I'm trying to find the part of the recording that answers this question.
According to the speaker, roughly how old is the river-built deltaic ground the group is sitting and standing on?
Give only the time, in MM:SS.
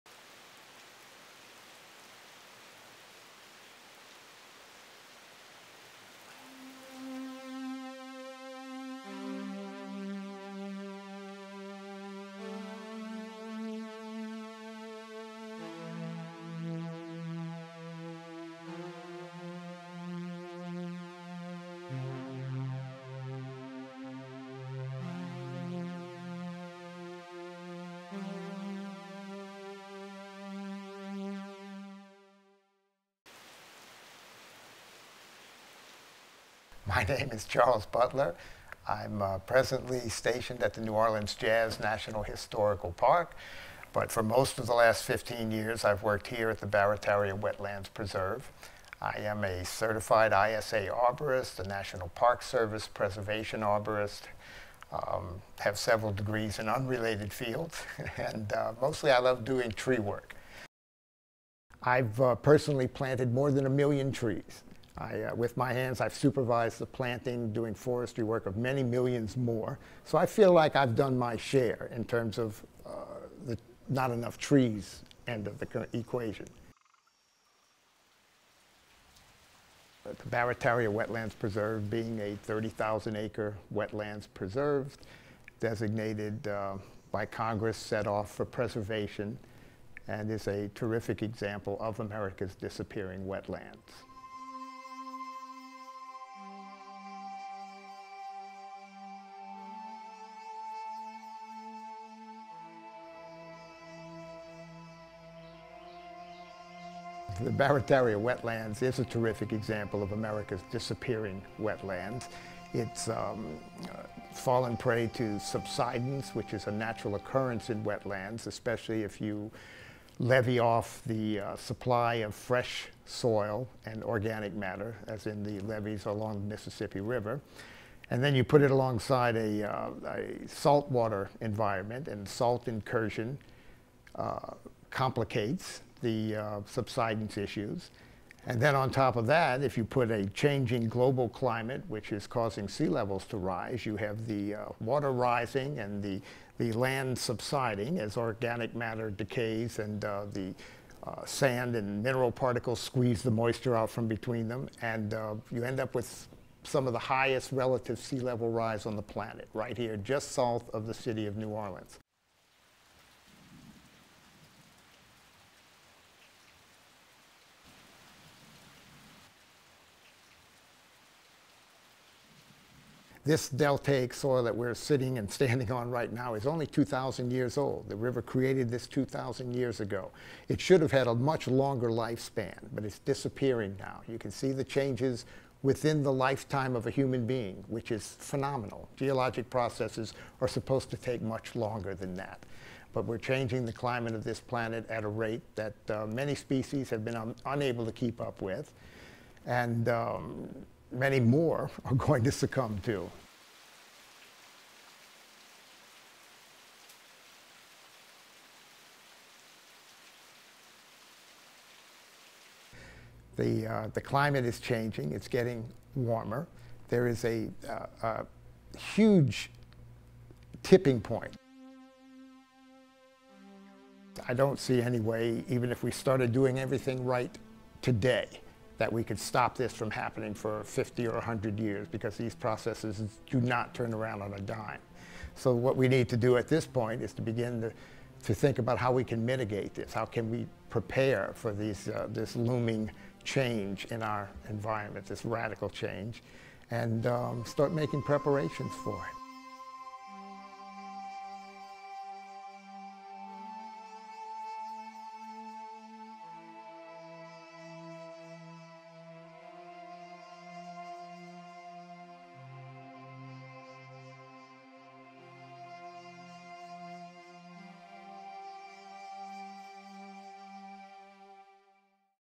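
02:56.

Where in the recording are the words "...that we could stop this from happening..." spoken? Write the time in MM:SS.
03:48.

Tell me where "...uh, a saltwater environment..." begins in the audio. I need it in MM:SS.
02:09.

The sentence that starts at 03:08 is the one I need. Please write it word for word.
Geologic processes are supposed to take much longer than that.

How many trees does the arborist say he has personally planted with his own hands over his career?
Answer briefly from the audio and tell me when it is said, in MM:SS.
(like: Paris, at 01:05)
more than 1,000,000, at 01:03.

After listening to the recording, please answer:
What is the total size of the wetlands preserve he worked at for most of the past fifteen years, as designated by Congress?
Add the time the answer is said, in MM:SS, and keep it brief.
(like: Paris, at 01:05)
30,000 acres, at 01:22.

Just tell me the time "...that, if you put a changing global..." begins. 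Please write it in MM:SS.
02:19.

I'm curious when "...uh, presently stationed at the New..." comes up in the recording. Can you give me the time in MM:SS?
00:39.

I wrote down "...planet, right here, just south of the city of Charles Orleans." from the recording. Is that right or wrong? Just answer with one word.
wrong.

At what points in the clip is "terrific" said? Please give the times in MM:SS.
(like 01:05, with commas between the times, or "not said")
01:30, 01:49.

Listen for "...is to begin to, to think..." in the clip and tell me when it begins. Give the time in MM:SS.
03:57.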